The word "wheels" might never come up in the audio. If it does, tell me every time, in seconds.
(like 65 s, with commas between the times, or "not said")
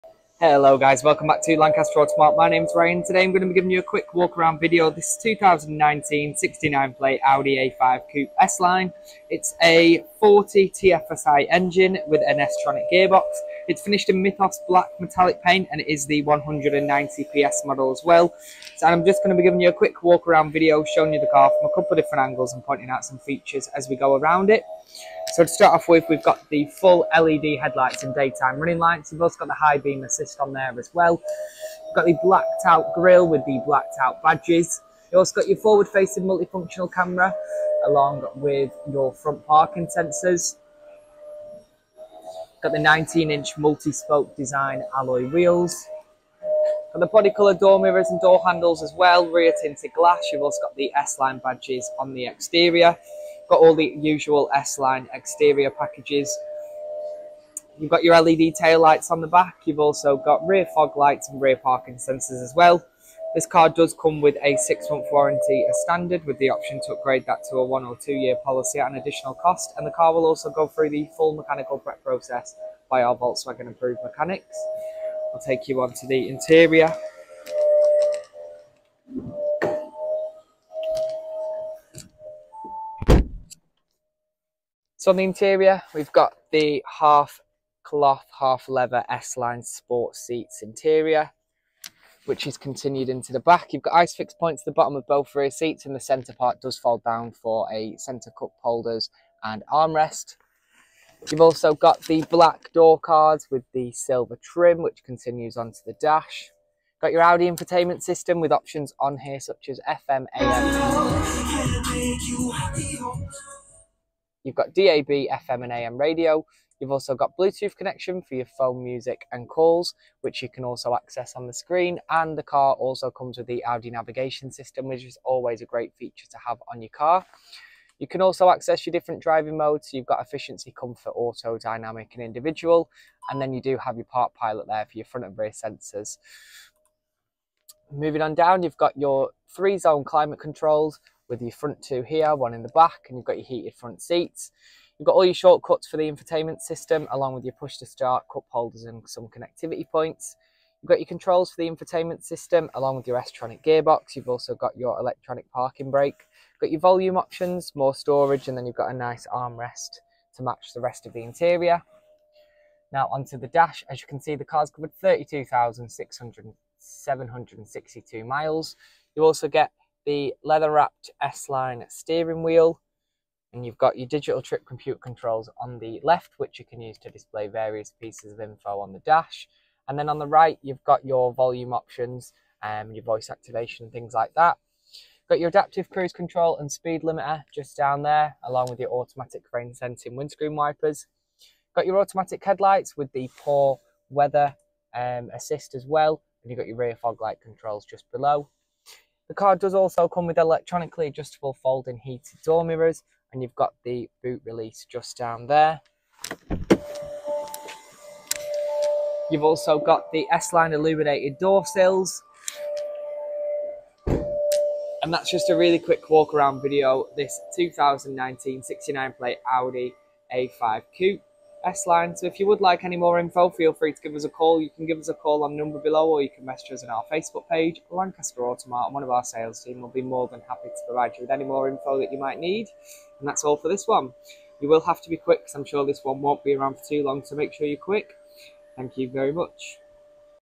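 45 s, 172 s.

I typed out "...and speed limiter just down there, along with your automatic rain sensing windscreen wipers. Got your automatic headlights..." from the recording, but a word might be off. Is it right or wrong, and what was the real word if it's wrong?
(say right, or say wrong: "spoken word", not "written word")
right.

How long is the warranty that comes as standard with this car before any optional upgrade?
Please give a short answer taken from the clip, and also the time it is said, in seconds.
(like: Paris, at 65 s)
6 months, at 64 s.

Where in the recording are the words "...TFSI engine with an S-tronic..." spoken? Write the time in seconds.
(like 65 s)
10 s.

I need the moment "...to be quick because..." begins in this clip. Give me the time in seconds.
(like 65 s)
235 s.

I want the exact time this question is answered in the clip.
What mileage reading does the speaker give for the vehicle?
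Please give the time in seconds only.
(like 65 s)
164 s.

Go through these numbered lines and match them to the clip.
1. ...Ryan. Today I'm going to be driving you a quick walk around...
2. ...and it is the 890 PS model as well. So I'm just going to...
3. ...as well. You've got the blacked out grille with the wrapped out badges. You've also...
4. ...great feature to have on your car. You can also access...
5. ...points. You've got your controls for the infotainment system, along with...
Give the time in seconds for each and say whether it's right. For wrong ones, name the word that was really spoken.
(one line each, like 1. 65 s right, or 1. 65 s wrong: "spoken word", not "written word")
1. 2 s wrong: "giving", not "driving"
2. 15 s wrong: "190", not "890"
3. 30 s wrong: "blacked", not "wrapped"
4. 125 s right
5. 149 s right.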